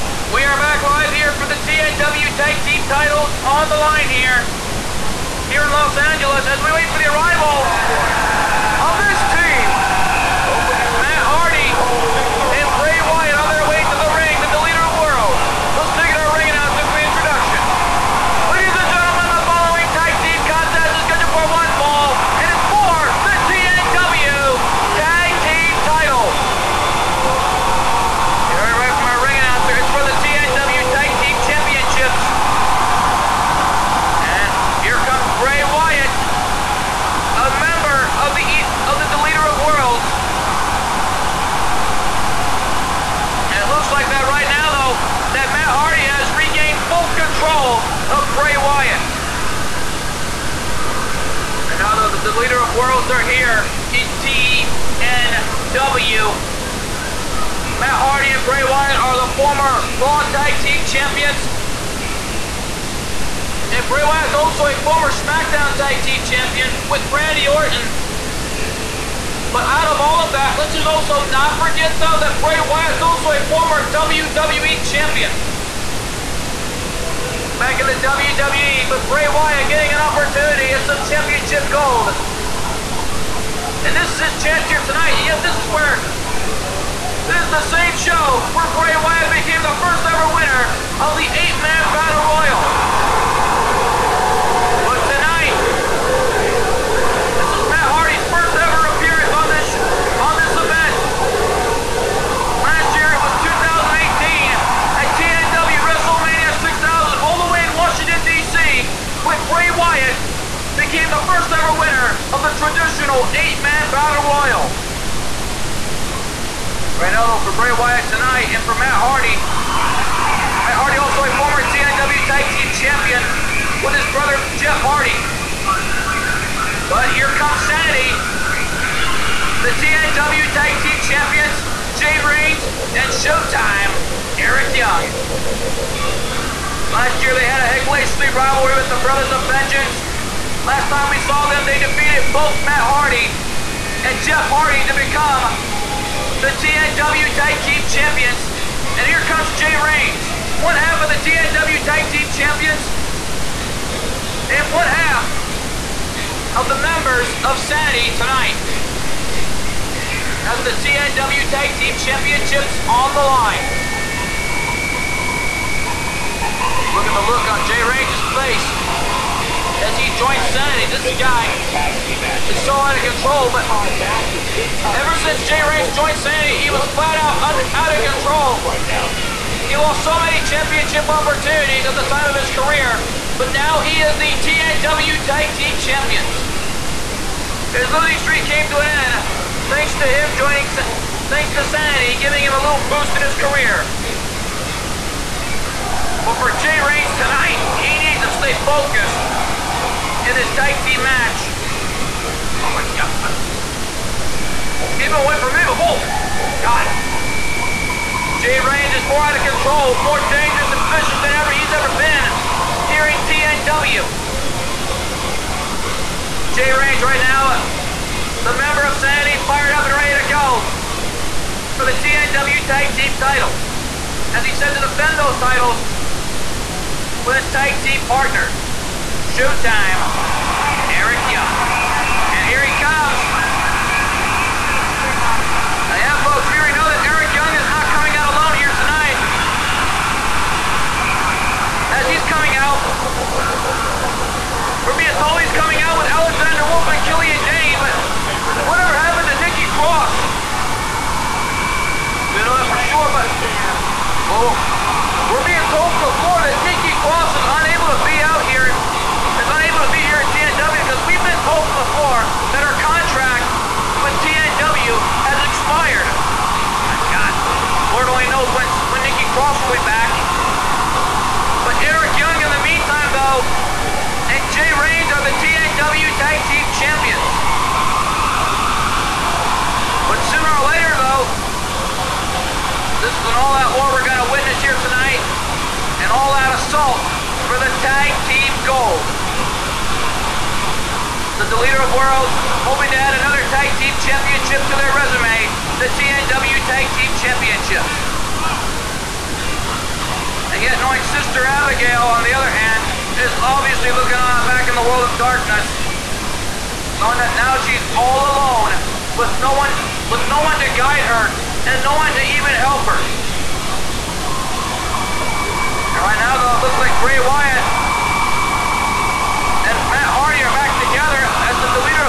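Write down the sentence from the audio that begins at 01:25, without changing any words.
Yet this is where this is the same show where Bray Wyatt became the first ever winner of the eight-man battle royal.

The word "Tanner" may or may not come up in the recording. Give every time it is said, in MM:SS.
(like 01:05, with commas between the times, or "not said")
not said.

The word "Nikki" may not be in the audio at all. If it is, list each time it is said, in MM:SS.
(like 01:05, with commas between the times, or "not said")
04:09, 04:16, 04:29.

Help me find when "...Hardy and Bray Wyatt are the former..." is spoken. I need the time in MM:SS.
00:58.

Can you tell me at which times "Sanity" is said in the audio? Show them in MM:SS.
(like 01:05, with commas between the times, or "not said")
02:07, 02:37, 02:50, 02:56, 03:11, 03:38.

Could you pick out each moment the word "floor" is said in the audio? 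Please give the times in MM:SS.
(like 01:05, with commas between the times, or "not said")
04:16, 04:21.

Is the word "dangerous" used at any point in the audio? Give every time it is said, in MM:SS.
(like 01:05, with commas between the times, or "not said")
03:30.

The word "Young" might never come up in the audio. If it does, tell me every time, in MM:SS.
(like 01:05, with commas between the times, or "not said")
02:14, 03:51, 03:57.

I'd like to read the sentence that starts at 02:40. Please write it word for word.
As the TNW Tag Team Championships on the line.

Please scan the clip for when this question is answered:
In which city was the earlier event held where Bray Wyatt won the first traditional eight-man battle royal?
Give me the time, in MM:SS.
01:47.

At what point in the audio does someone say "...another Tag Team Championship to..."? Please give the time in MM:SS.
04:53.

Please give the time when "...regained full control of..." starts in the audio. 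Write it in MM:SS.
00:46.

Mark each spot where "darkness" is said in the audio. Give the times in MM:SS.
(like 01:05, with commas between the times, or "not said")
05:05.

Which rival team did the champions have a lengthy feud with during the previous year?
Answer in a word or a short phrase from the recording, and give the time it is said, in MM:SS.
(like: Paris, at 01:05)
Brothers of Vengeance, at 02:19.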